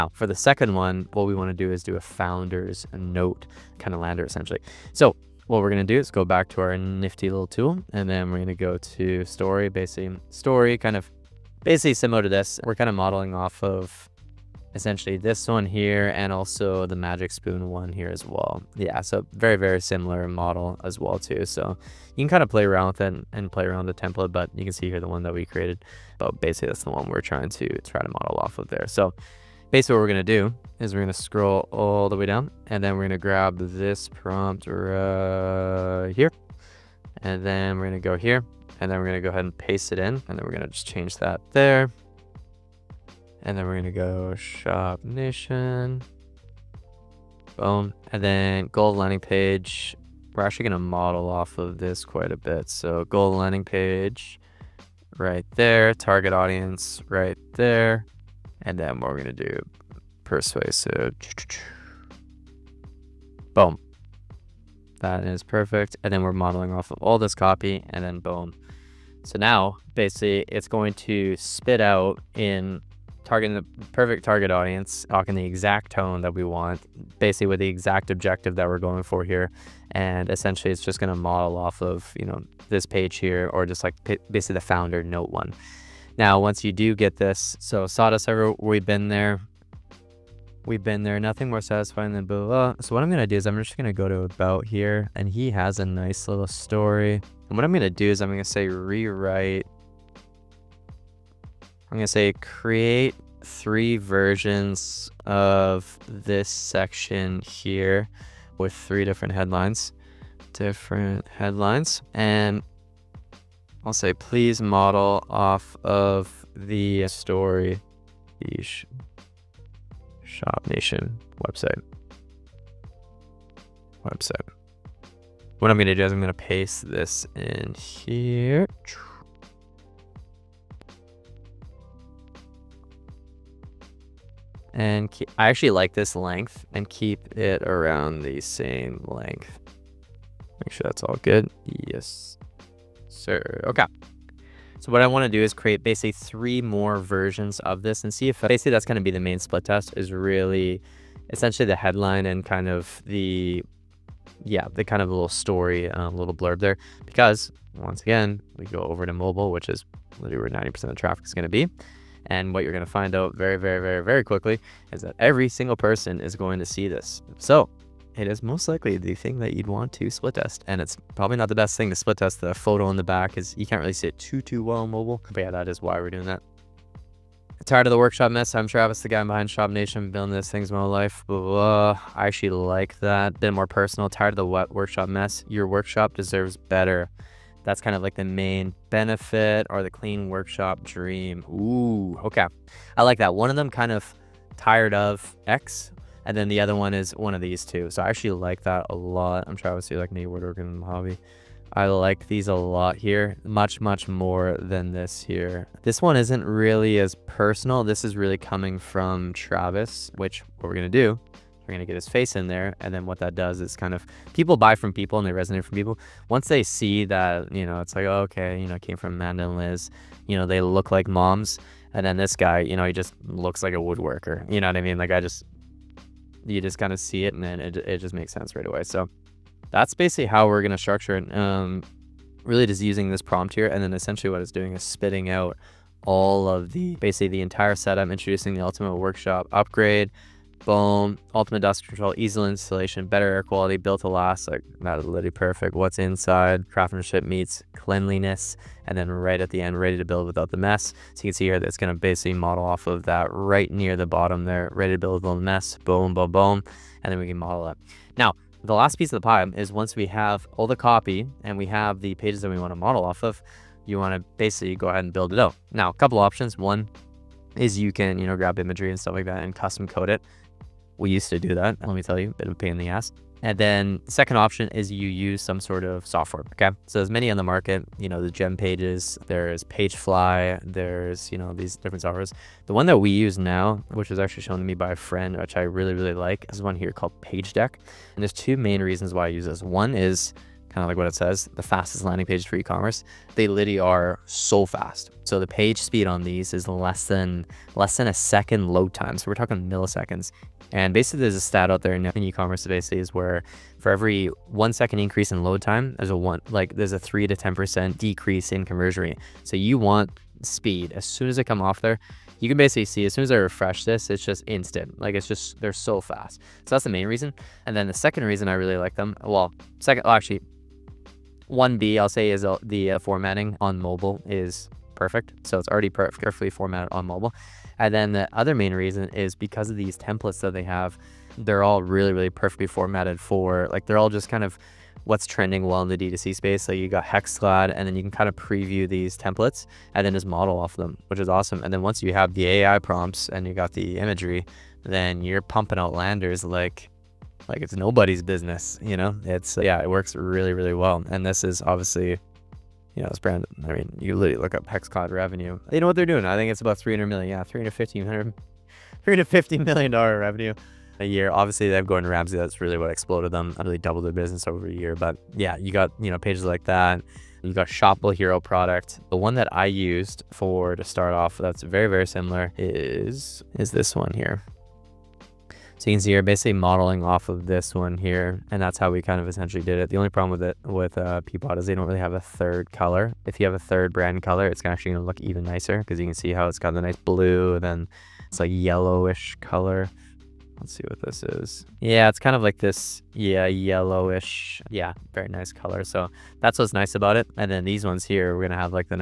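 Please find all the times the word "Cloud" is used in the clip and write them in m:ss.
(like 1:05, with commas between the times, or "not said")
5:54.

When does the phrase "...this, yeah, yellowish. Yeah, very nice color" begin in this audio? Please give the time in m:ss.
6:32.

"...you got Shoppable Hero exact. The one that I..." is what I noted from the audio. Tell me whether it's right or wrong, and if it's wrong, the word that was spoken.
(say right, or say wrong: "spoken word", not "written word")
wrong: "product", not "exact".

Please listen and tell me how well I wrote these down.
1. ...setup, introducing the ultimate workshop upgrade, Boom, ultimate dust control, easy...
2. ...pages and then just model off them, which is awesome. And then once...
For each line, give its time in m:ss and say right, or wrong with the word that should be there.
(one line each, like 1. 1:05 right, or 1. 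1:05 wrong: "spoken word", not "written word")
1. 3:57 right
2. 5:39 wrong: "templates", not "pages".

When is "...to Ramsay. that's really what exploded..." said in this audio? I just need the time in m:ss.
6:02.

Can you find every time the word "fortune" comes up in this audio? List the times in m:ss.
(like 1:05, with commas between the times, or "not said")
not said.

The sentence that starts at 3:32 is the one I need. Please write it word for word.
And then what that does is kind of people buy from people and they resonate from people.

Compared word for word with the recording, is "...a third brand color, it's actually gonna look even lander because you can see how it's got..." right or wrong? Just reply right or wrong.
wrong.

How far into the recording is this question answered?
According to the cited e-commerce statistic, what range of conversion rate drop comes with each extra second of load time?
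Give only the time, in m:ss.
5:06.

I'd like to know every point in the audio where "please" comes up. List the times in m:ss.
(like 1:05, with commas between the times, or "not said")
1:54.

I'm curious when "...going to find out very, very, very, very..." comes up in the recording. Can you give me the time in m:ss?
2:42.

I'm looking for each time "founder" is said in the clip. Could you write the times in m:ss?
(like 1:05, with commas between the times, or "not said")
0:02, 1:24.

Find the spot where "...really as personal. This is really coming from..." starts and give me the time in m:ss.
3:26.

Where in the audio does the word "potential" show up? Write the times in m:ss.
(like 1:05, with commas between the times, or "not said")
not said.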